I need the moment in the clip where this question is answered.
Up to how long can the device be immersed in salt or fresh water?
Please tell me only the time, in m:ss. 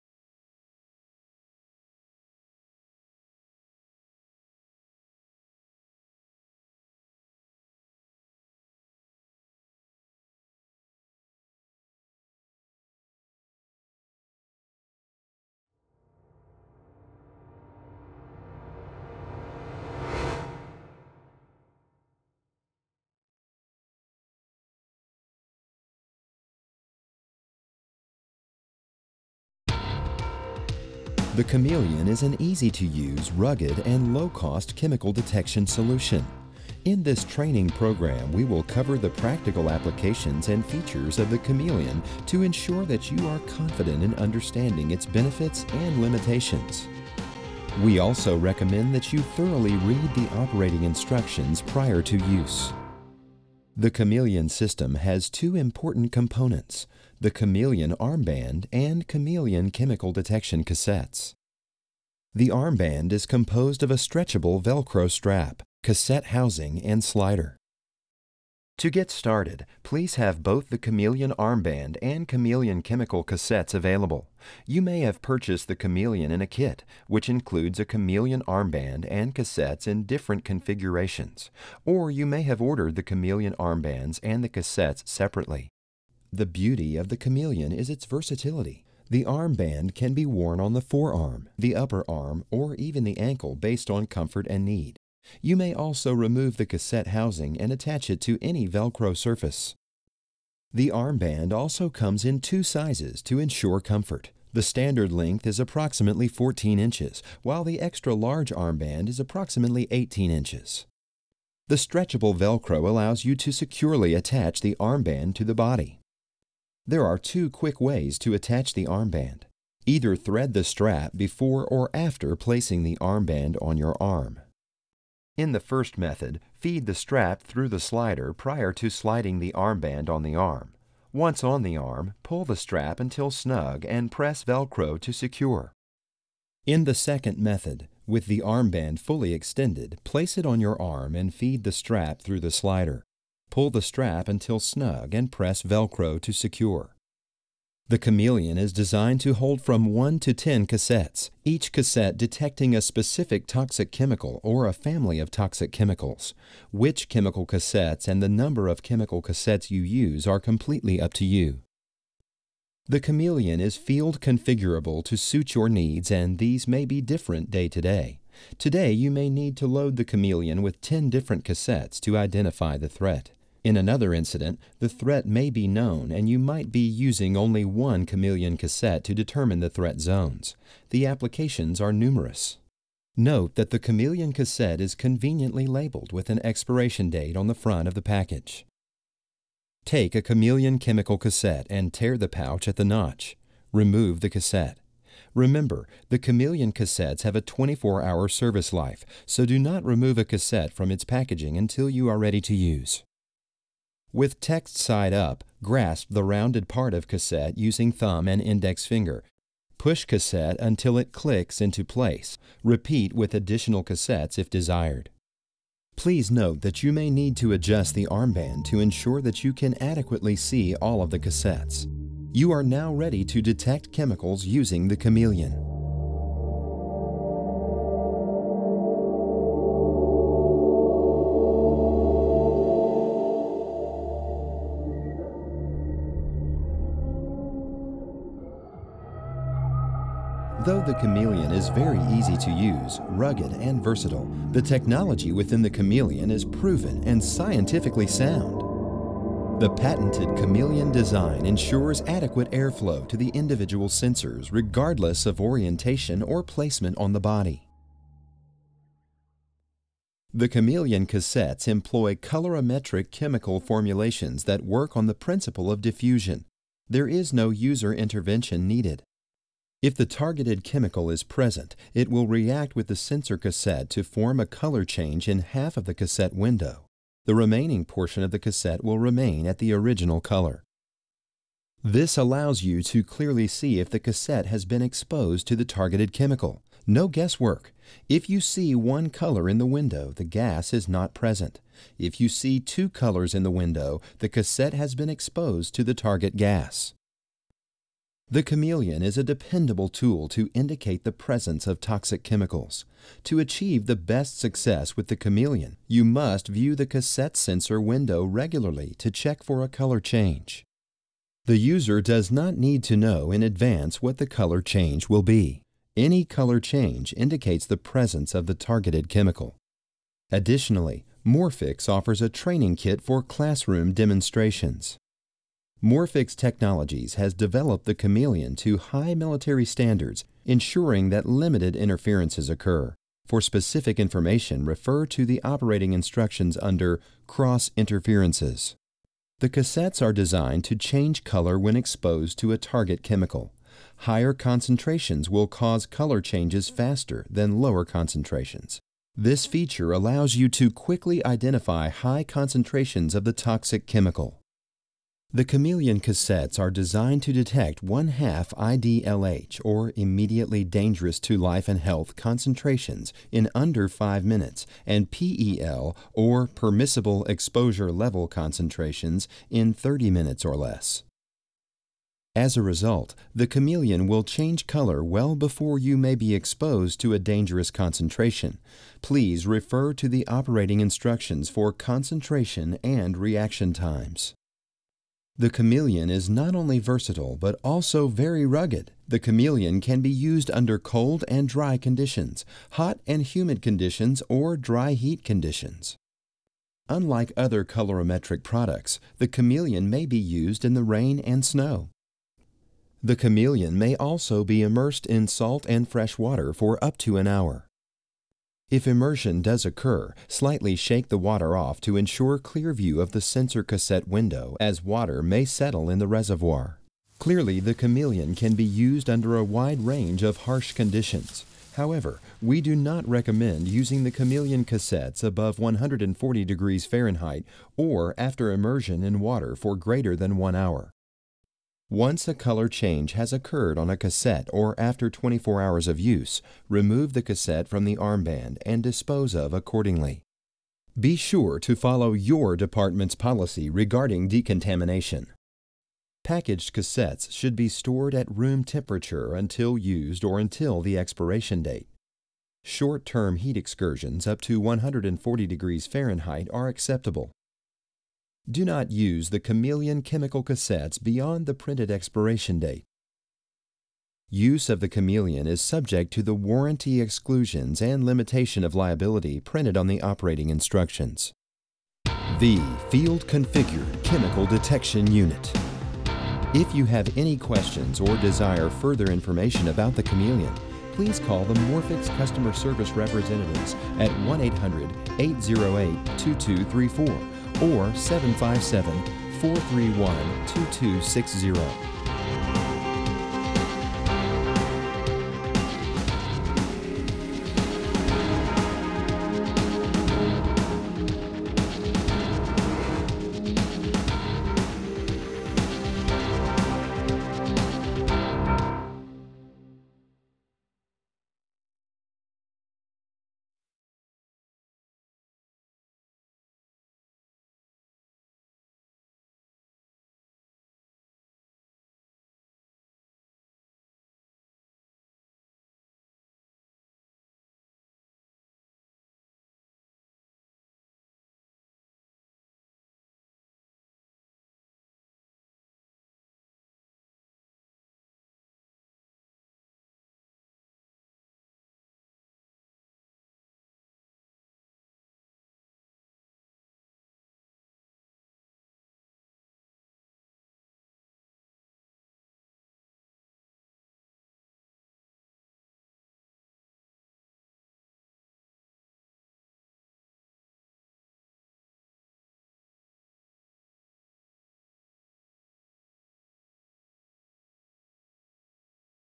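6:46.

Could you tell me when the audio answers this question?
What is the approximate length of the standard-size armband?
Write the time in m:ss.
1:45.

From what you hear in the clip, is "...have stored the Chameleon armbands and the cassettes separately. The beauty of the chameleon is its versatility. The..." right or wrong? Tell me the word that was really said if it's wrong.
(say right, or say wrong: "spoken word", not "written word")
wrong: "ordered", not "stored".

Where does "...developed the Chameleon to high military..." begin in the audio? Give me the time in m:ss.
5:27.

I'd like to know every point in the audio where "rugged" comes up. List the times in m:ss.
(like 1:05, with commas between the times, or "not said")
0:33, 4:03, 6:28.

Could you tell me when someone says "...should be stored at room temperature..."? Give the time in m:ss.
7:27.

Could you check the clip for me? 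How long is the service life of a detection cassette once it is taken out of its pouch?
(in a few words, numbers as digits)
24 hours.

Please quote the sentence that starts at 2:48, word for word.
Today you may need to load the Chameleon with 10 different cassettes to identify the threat.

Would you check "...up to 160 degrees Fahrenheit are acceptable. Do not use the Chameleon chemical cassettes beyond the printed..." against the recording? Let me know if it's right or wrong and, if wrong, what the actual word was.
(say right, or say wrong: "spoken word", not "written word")
wrong: "140", not "160".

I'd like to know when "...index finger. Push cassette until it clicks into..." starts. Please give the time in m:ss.
3:28.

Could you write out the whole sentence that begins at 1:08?
To get started, please have both the Chameleon armband and Chameleon chemical cassettes available.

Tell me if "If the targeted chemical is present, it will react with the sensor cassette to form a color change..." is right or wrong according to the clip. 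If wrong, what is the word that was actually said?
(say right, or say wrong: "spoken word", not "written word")
right.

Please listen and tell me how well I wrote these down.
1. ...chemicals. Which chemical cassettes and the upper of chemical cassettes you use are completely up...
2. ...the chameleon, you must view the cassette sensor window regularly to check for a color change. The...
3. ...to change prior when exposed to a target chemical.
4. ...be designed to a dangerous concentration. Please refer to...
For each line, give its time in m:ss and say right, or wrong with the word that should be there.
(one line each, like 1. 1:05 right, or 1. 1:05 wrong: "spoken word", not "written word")
1. 2:35 wrong: "number", not "upper"
2. 5:05 right
3. 5:40 wrong: "color", not "prior"
4. 6:16 wrong: "exposed", not "designed".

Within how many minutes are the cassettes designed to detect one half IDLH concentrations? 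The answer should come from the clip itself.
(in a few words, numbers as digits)
5 minutes.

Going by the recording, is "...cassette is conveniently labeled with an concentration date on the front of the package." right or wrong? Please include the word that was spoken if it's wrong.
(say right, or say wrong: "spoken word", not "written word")
wrong: "expiration", not "concentration".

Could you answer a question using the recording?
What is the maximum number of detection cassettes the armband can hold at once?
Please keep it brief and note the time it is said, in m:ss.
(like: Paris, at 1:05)
10, at 2:29.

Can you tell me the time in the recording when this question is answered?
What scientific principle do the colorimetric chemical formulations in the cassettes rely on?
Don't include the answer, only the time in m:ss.
4:25.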